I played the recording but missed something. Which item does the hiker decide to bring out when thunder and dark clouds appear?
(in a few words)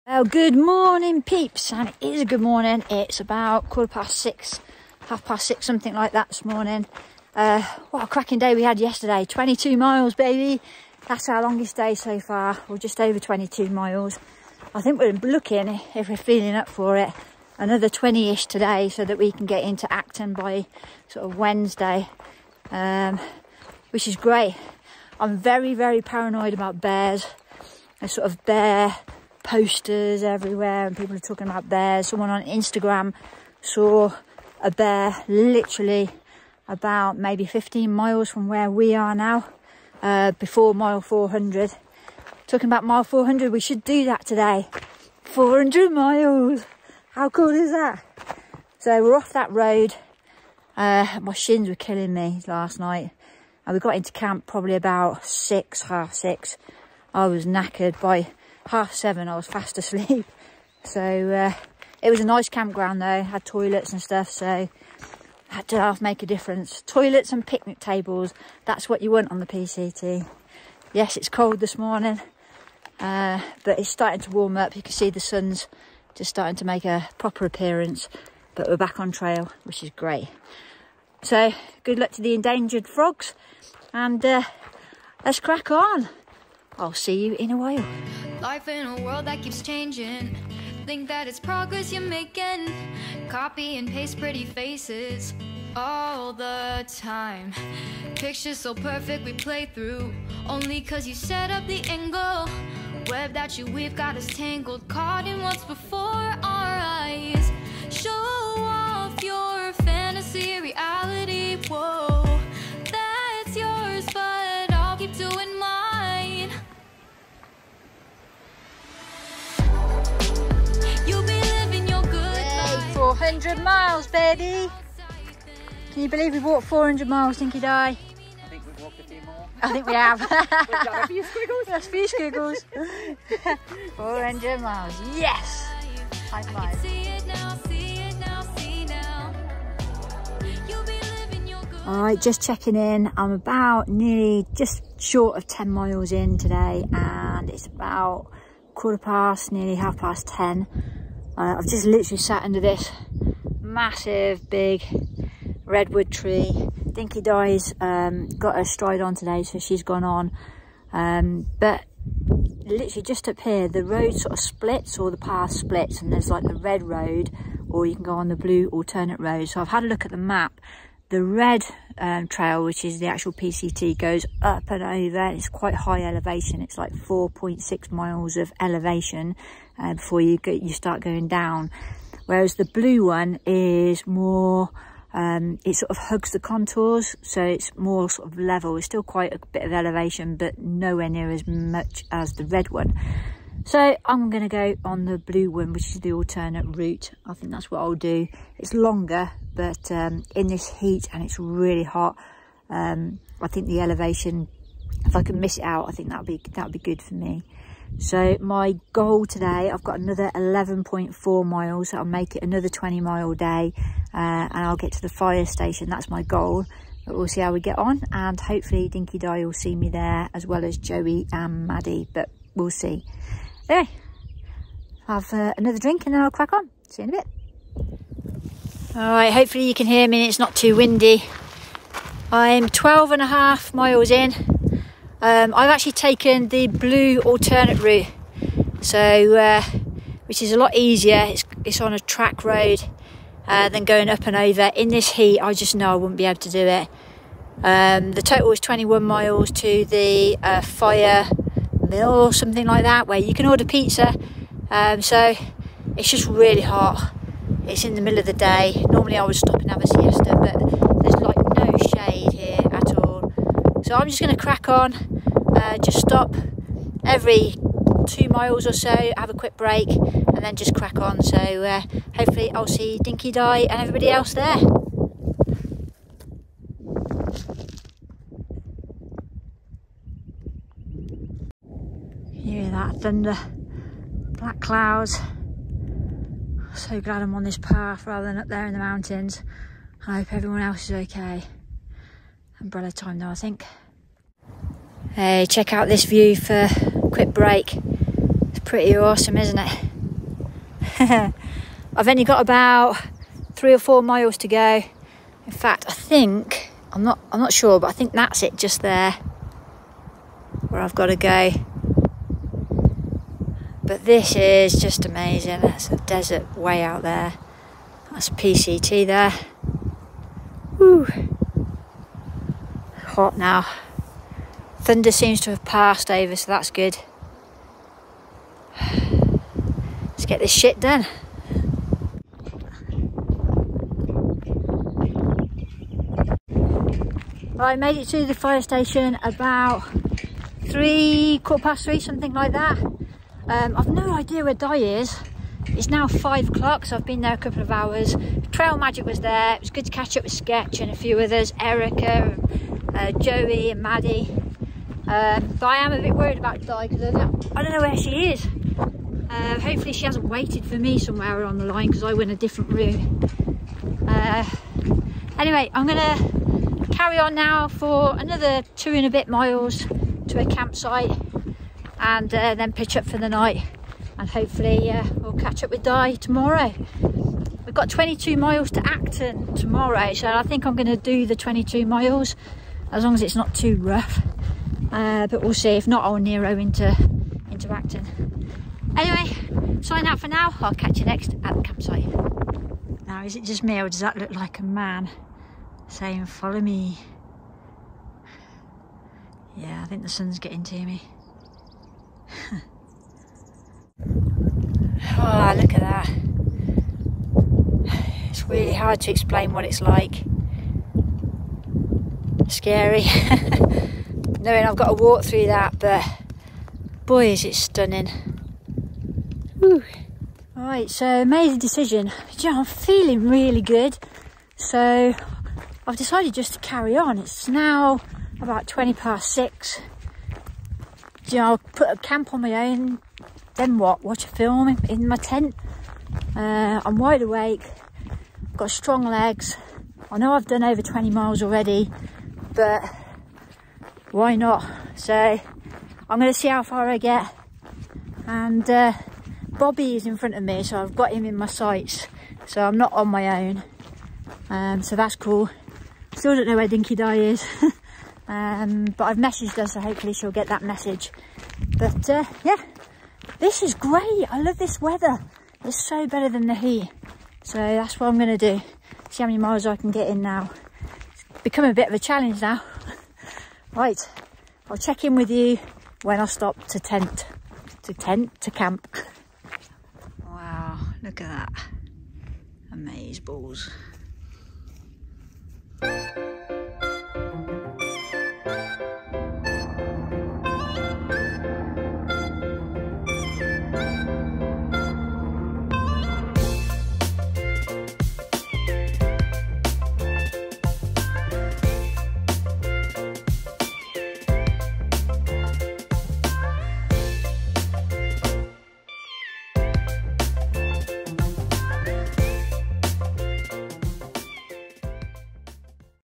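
umbrella.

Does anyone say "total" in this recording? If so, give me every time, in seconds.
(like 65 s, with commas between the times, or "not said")
248 s.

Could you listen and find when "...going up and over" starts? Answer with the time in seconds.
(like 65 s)
243 s.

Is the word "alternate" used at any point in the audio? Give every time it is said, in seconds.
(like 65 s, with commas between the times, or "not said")
168 s, 196 s, 237 s.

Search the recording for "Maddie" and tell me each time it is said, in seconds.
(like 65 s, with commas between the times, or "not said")
221 s, 353 s.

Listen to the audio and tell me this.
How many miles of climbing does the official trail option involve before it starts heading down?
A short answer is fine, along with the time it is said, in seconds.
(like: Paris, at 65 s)
4.6 miles, at 176 s.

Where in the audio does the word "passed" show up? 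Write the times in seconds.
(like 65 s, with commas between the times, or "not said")
325 s.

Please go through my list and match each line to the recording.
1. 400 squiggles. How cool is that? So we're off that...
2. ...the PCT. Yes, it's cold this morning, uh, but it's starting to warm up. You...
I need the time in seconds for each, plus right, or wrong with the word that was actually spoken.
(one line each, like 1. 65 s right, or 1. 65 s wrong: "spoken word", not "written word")
1. 45 s wrong: "miles", not "squiggles"
2. 69 s right.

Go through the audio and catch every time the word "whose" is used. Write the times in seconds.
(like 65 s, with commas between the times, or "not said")
not said.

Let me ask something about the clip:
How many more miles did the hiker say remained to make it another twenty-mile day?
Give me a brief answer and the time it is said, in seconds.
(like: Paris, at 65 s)
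11.4 miles, at 210 s.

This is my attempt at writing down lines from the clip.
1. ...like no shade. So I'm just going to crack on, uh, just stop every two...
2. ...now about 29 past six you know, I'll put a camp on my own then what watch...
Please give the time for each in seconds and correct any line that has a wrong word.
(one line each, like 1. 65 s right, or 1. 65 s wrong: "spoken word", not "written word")
1. 261 s right
2. 427 s wrong: "20", not "29".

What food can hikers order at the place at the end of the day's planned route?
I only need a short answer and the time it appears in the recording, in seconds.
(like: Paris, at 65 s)
pizza, at 253 s.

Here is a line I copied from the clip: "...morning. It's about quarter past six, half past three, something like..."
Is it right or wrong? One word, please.
wrong.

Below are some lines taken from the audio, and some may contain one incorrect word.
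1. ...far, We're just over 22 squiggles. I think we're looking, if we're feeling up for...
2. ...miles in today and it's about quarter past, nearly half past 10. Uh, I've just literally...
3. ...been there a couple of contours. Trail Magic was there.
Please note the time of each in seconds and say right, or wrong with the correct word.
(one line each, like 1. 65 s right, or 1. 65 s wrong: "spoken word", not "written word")
1. 12 s wrong: "miles", not "squiggles"
2. 145 s right
3. 347 s wrong: "hours", not "contours".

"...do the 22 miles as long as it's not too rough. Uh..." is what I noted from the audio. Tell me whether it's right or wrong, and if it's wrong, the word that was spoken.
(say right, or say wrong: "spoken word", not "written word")
right.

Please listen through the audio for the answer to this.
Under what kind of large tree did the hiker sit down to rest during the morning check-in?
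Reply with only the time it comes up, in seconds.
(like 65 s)
155 s.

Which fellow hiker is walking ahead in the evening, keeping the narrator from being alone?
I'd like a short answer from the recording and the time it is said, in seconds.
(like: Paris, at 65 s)
Bobby, at 449 s.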